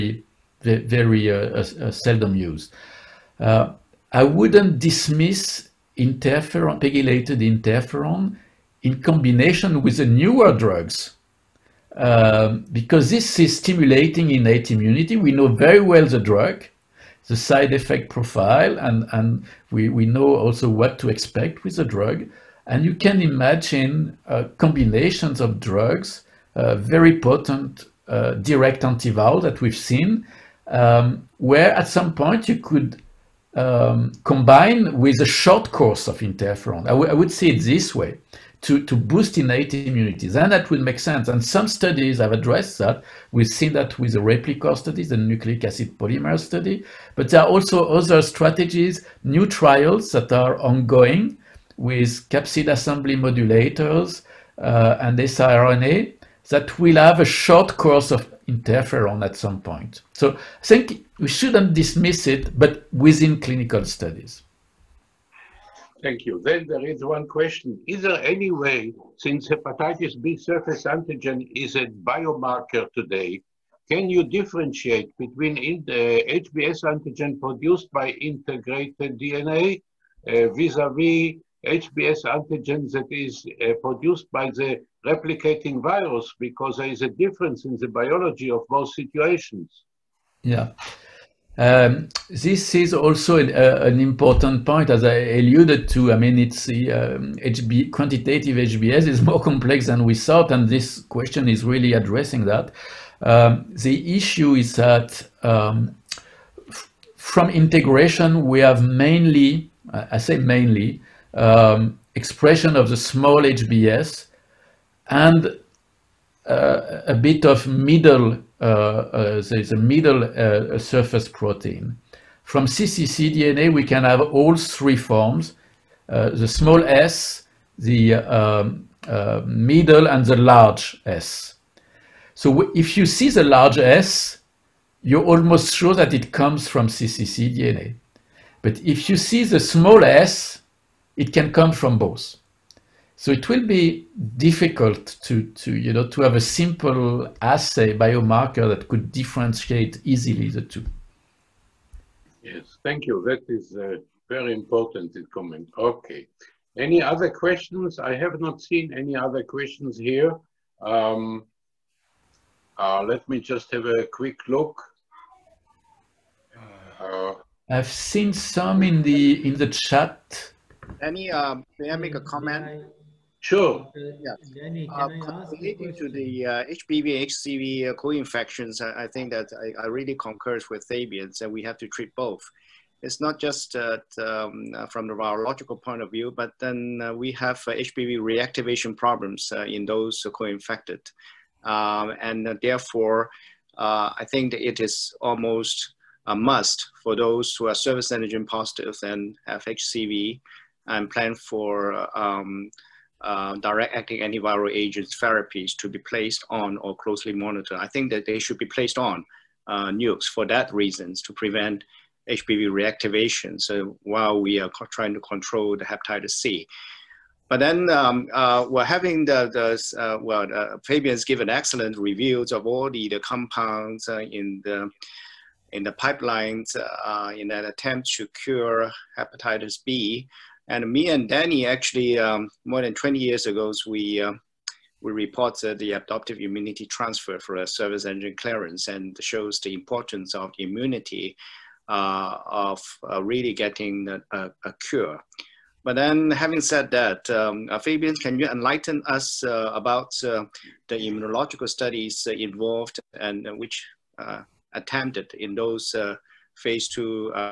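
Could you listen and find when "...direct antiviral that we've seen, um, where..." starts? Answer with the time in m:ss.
0:28.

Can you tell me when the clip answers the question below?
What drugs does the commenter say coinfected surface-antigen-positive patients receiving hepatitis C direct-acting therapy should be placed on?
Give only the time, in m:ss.
3:29.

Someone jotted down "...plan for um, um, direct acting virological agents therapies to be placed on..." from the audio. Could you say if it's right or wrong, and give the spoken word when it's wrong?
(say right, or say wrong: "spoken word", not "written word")
wrong: "antiviral", not "virological".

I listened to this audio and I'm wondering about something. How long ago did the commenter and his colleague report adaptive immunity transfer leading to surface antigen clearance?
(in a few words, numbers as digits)
More than 20 years ago.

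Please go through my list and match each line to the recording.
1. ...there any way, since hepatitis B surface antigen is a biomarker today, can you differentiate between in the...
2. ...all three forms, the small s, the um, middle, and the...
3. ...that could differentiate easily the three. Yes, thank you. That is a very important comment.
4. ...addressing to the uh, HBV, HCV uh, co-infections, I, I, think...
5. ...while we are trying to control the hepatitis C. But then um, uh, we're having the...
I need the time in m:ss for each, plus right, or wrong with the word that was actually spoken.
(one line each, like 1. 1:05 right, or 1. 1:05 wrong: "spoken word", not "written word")
1. 1:08 right
2. 2:04 right
3. 2:28 wrong: "two", not "three"
4. 2:55 wrong: "relating", not "addressing"
5. 3:34 right.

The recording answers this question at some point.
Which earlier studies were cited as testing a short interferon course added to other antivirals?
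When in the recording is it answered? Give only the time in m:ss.
0:44.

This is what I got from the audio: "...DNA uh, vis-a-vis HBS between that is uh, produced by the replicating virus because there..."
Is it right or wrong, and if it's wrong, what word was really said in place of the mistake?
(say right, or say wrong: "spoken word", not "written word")
wrong: "antigen", not "between".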